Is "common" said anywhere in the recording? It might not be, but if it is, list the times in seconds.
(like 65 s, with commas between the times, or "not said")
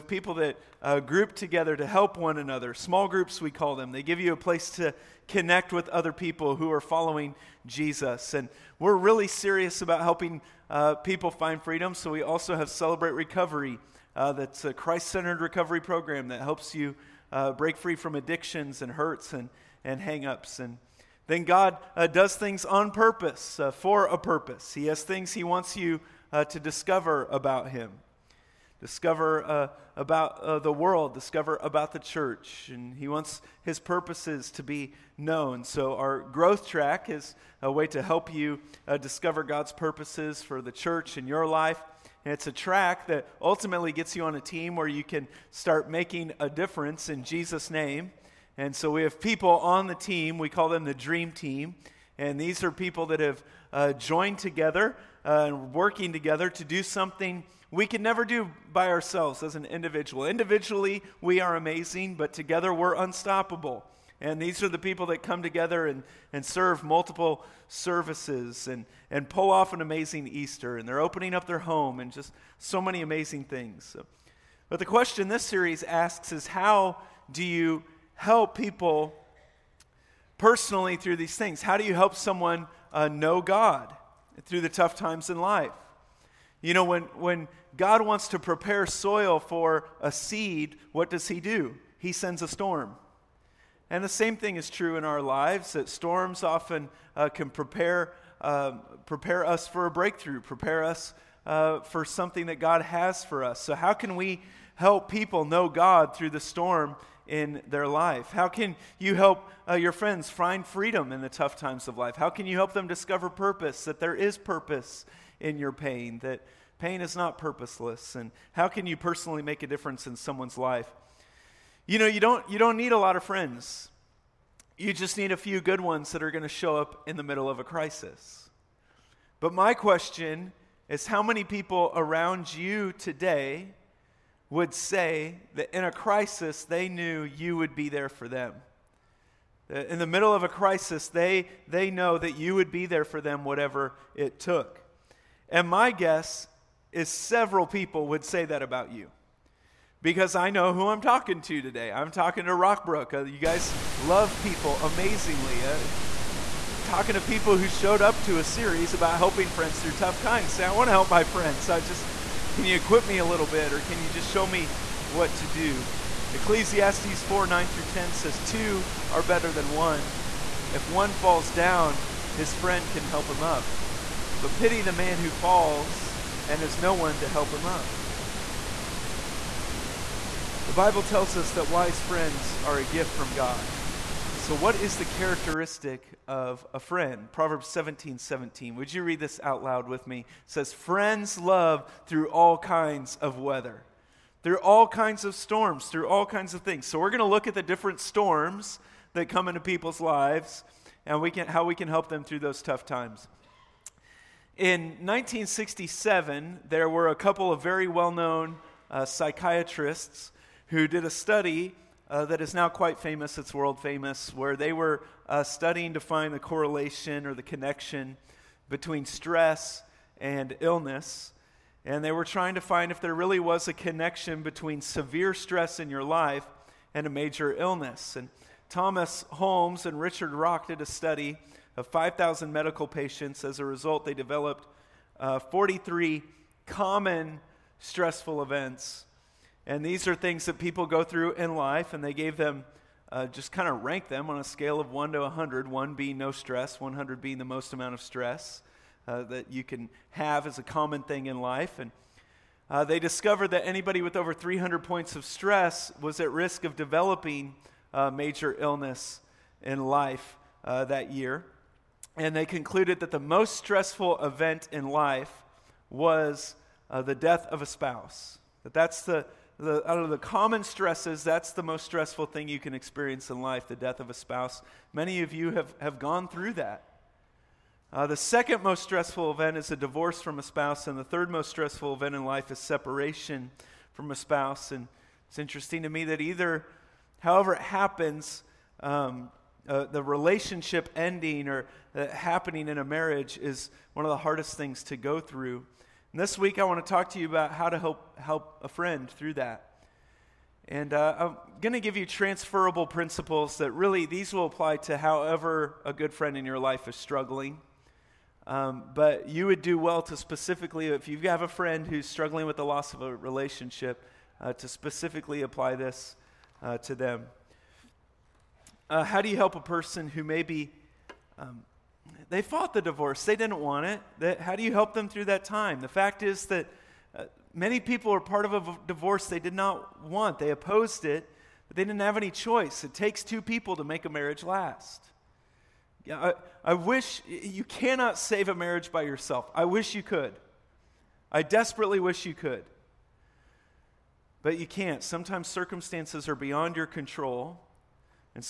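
236 s, 250 s, 270 s.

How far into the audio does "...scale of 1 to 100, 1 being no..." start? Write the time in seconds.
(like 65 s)
244 s.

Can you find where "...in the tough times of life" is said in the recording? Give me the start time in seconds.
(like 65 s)
111 s.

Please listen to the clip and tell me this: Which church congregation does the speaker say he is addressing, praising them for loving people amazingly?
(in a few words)
Rockbrook.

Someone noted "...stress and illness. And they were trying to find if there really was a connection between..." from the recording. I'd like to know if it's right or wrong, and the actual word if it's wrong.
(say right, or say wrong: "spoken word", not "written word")
right.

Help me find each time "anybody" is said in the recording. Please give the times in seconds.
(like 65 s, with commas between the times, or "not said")
253 s.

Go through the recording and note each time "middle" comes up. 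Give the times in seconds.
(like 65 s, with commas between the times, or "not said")
127 s, 140 s.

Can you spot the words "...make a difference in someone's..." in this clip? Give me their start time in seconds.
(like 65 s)
119 s.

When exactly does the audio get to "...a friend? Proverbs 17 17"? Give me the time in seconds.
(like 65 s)
186 s.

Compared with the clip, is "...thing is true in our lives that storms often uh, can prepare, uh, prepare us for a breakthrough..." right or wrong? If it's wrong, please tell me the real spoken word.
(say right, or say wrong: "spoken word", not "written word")
right.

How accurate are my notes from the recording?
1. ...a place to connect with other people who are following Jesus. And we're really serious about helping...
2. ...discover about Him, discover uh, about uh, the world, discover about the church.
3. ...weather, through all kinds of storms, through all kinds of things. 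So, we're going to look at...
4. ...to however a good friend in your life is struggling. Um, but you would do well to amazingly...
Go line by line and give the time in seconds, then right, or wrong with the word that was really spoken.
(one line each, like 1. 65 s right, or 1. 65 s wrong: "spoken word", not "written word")
1. 4 s right
2. 26 s right
3. 193 s right
4. 304 s wrong: "specifically", not "amazingly".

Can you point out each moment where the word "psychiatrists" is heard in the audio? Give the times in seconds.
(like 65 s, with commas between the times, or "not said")
209 s.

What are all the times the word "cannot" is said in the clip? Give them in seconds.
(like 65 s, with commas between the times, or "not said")
337 s.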